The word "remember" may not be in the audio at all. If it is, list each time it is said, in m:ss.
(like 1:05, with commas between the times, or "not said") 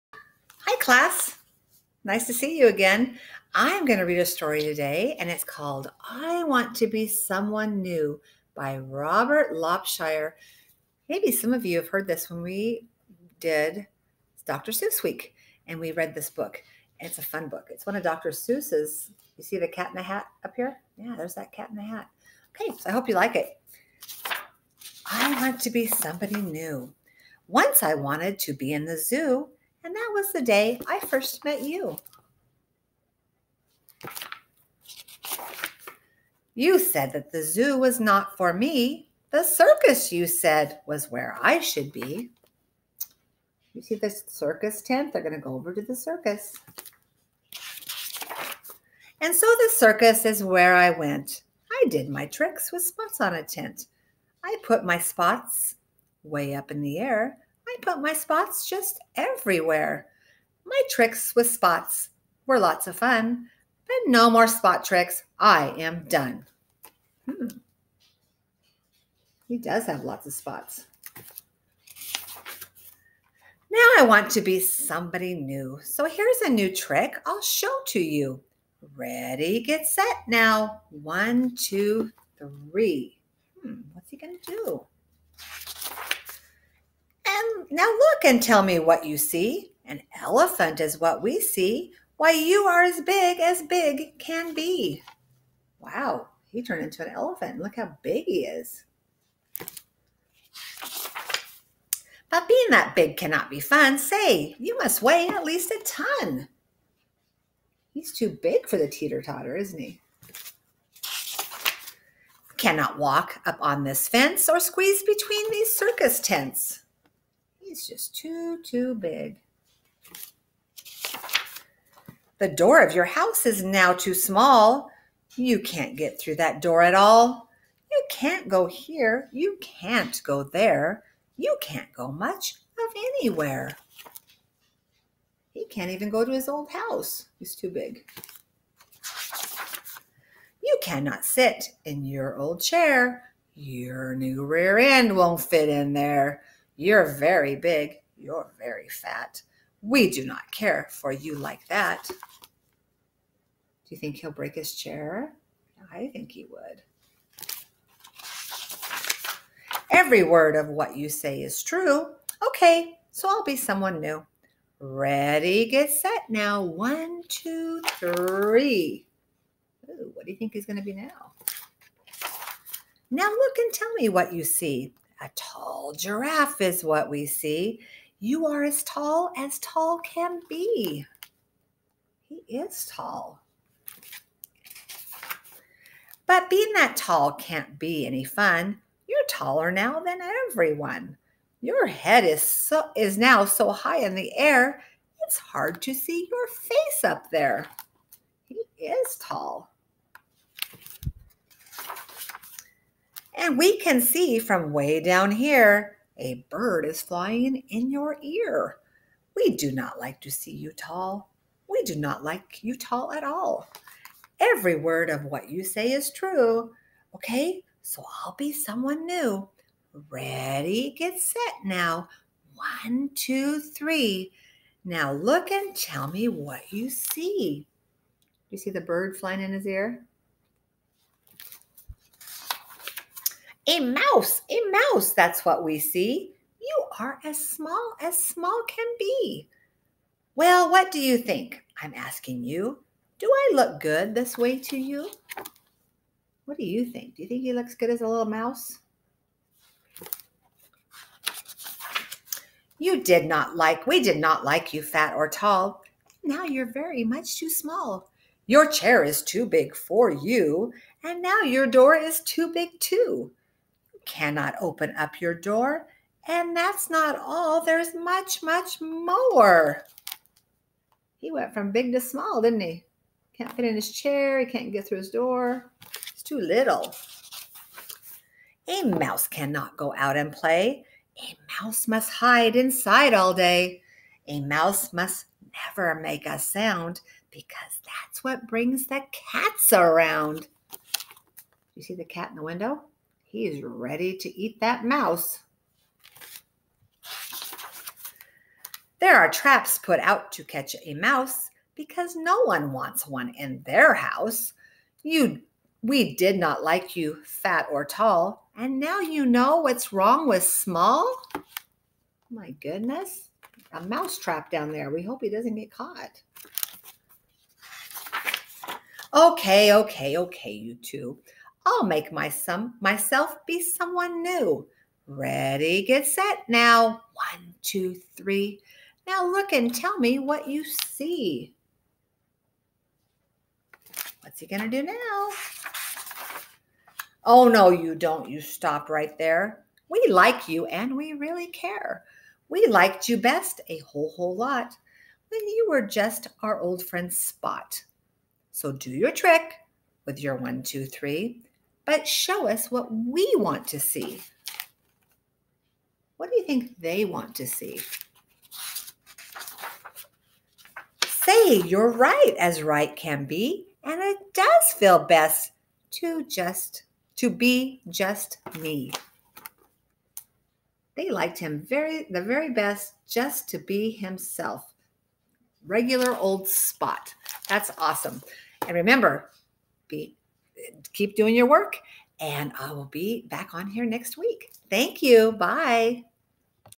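6:18.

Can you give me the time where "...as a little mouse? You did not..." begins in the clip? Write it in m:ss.
4:07.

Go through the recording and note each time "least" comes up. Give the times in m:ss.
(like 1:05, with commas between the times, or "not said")
1:45.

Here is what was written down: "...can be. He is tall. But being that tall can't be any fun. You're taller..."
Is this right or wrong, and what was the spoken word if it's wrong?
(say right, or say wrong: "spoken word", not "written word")
right.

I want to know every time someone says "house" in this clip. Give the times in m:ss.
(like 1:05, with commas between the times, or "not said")
2:03, 2:16, 5:03.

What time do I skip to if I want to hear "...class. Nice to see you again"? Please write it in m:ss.
0:00.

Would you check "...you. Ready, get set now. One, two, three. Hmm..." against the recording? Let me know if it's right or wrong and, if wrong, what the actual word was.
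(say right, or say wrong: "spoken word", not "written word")
right.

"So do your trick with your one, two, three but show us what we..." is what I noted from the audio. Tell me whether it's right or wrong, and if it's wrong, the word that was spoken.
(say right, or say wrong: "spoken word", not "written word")
right.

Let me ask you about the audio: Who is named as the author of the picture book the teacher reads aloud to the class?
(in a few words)
Robert Lopshire.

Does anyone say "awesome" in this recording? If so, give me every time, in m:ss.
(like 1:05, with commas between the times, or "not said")
6:17.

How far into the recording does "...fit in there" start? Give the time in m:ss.
2:25.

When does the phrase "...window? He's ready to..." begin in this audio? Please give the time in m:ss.
4:52.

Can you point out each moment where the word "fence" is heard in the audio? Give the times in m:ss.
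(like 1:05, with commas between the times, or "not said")
1:54.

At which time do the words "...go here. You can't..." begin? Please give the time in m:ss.
2:08.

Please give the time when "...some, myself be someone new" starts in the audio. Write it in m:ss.
5:22.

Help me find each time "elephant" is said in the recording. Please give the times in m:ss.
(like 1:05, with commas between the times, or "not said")
1:30, 1:37.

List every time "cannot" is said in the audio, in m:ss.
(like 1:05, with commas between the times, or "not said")
1:43, 1:52, 2:20, 4:24, 4:39.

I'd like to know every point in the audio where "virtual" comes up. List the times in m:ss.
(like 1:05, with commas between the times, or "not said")
not said.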